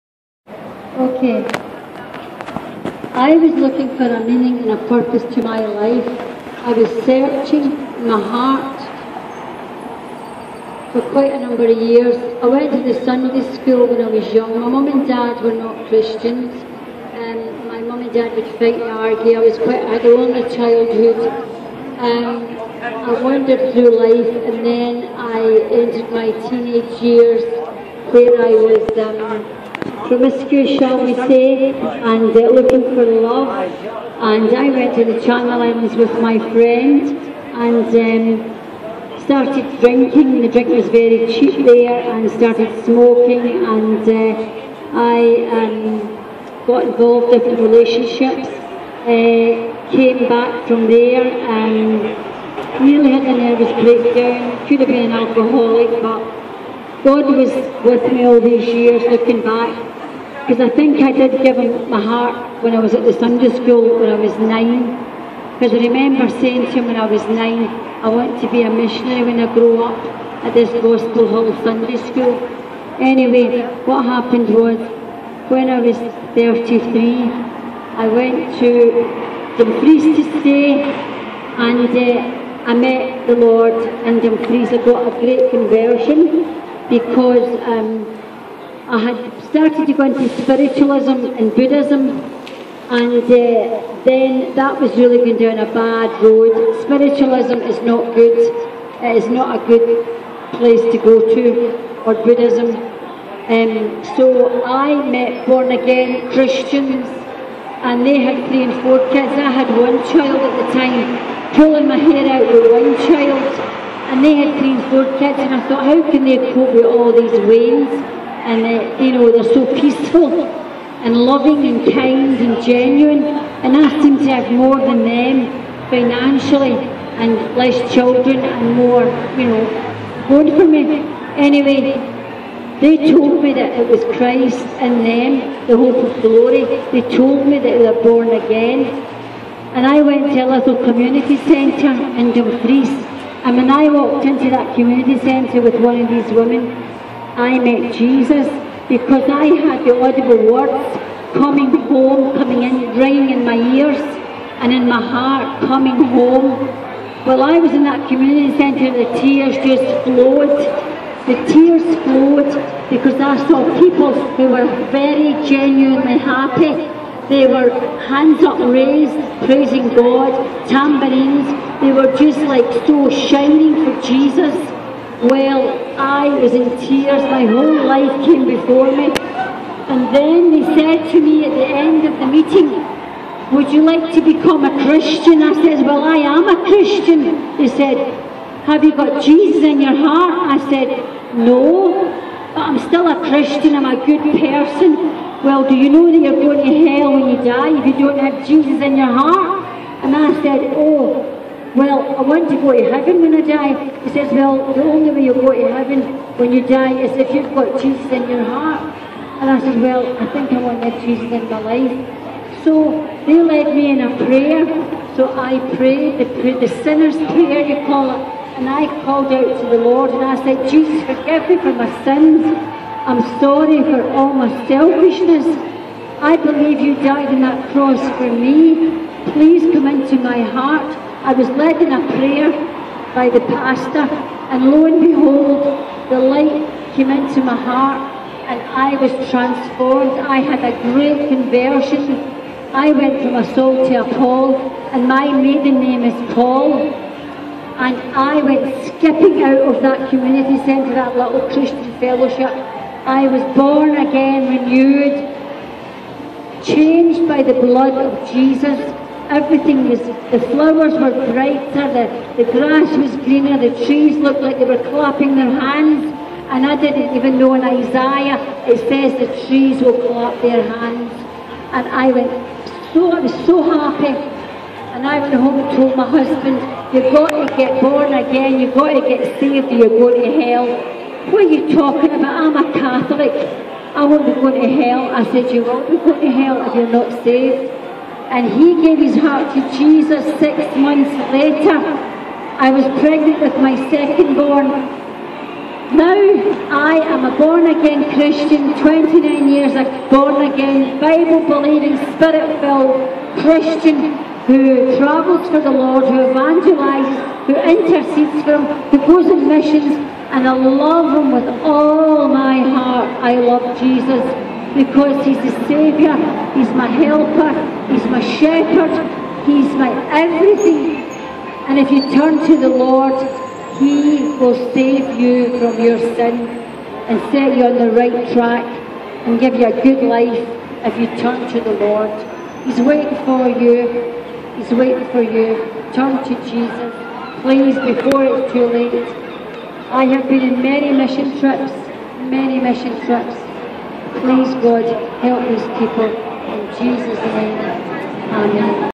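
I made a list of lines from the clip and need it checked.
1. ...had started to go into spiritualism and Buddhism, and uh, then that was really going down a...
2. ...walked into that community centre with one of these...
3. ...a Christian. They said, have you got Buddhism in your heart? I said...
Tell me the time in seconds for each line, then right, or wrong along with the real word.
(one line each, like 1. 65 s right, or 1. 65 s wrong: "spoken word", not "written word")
1. 88 s right
2. 143 s right
3. 186 s wrong: "Jesus", not "Buddhism".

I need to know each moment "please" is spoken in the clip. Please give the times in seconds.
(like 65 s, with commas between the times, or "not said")
229 s, 337 s, 344 s.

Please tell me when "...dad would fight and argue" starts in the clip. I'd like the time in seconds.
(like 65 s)
18 s.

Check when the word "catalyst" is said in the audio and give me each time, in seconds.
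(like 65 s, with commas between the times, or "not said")
not said.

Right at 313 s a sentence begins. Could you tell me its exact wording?
I love Jesus because he's the Saviour, he's my helper, he's my shepherd, he's my everything.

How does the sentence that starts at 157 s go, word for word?
While I was in that community centre, the tears just flowed.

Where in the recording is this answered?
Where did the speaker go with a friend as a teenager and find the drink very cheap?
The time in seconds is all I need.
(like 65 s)
35 s.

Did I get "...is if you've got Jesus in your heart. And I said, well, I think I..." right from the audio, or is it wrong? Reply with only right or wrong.
right.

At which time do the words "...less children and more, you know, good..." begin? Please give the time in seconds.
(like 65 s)
127 s.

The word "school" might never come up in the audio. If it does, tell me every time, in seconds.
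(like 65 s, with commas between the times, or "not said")
13 s, 30 s, 63 s, 72 s.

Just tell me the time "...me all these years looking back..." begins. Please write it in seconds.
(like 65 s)
58 s.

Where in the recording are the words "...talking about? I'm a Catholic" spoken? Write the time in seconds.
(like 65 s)
281 s.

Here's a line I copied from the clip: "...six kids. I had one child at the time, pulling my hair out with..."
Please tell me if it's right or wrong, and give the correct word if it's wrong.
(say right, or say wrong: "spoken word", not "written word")
wrong: "four", not "six".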